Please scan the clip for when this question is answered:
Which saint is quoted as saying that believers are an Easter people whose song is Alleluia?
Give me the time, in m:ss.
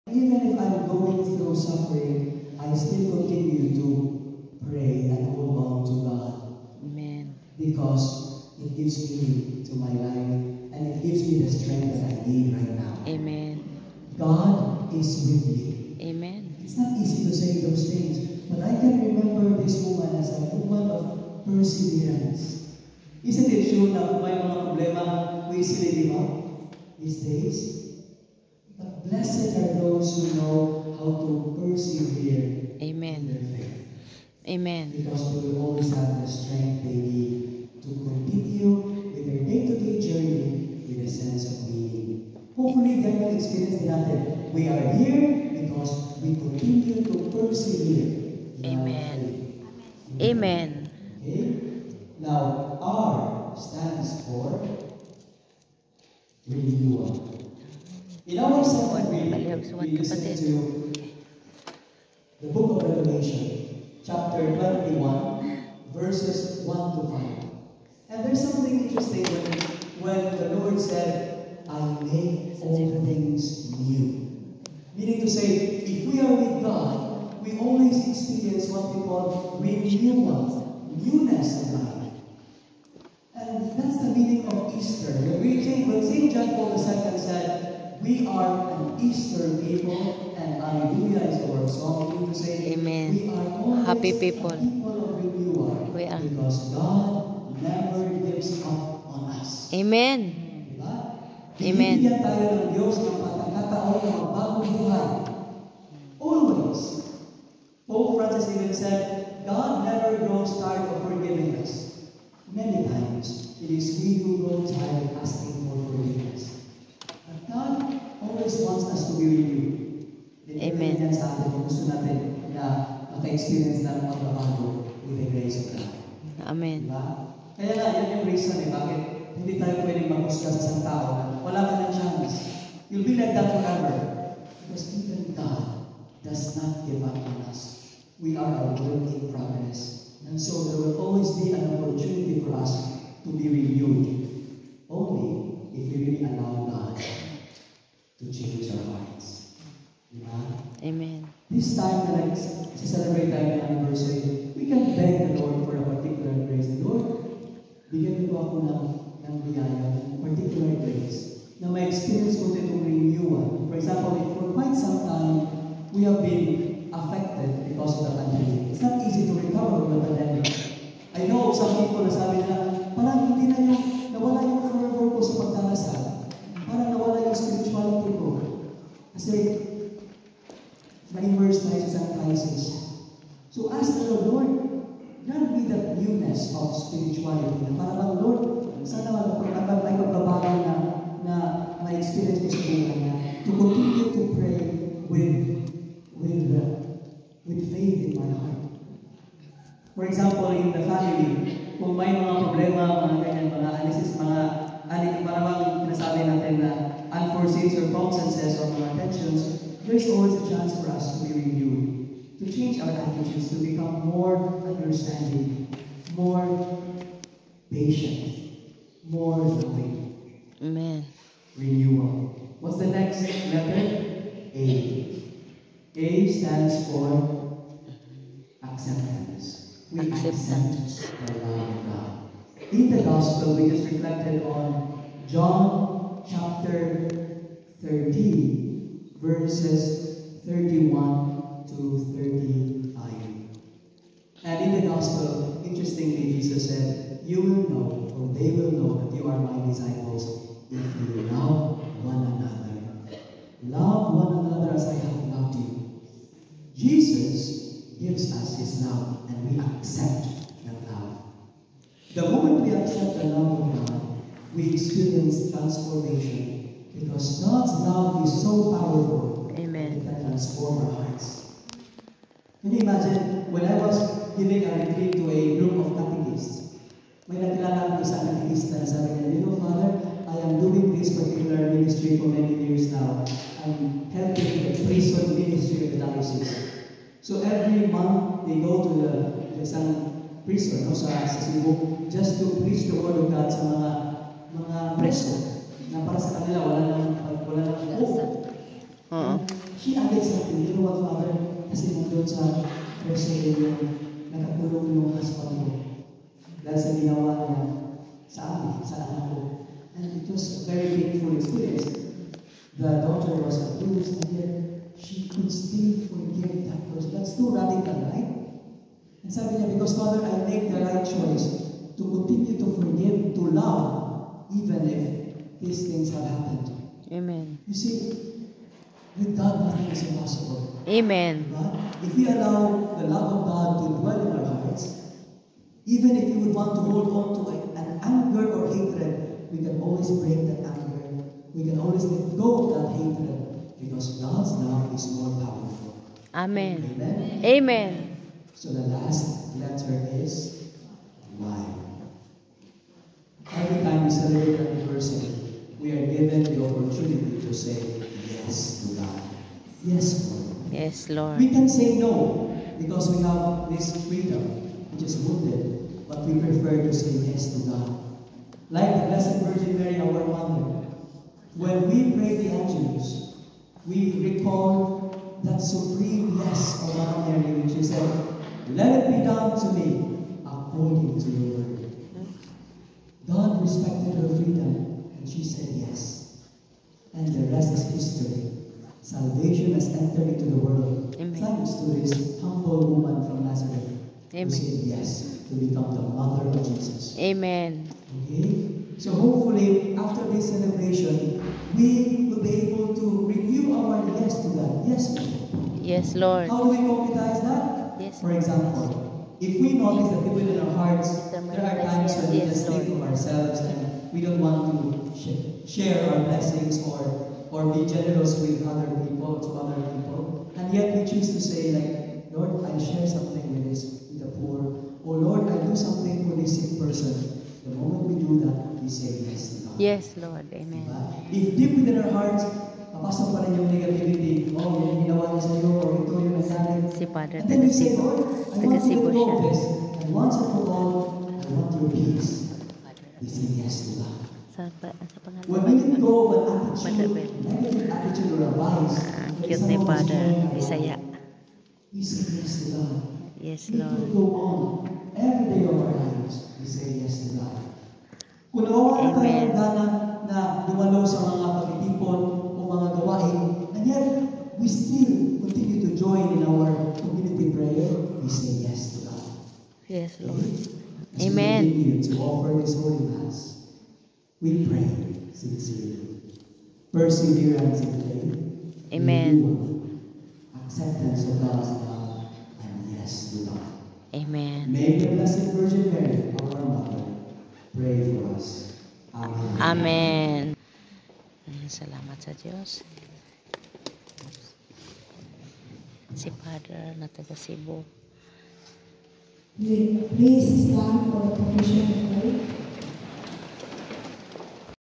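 1:26.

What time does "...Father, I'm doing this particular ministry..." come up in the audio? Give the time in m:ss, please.
4:39.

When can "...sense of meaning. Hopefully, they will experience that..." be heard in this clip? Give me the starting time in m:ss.
0:41.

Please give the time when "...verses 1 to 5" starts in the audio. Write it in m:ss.
1:05.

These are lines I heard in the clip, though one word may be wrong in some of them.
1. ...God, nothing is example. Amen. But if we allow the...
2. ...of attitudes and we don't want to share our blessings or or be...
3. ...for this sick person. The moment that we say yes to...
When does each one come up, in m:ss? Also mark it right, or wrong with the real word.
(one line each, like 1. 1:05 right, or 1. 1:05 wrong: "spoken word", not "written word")
1. 5:29 wrong: "impossible", not "example"
2. 6:52 wrong: "ourselves", not "attitudes"
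3. 7:06 right.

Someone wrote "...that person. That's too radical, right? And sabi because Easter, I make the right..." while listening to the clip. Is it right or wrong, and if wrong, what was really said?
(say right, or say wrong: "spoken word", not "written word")
wrong: "Father", not "Easter".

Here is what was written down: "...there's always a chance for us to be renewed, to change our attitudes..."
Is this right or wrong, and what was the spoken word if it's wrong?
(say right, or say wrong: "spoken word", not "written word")
right.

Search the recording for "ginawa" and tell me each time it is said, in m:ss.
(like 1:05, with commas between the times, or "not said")
5:06, 7:15.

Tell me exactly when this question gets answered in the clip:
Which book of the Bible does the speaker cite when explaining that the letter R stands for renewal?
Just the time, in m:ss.
1:02.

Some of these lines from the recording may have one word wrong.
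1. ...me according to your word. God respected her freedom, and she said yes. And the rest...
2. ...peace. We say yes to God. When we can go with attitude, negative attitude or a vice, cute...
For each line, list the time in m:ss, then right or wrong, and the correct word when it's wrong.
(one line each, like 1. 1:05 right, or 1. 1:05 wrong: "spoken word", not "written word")
1. 6:19 right
2. 7:21 right.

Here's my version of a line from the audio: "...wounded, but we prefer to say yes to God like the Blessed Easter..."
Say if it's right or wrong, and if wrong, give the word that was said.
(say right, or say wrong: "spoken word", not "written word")
wrong: "Virgin", not "Easter".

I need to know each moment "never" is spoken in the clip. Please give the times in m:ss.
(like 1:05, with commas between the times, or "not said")
1:37, 1:49.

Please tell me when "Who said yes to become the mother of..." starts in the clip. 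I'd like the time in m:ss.
6:34.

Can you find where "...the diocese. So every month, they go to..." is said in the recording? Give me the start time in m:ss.
4:45.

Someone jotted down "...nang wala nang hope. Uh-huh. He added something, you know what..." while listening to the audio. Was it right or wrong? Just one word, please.
right.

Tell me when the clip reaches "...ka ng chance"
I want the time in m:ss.
2:11.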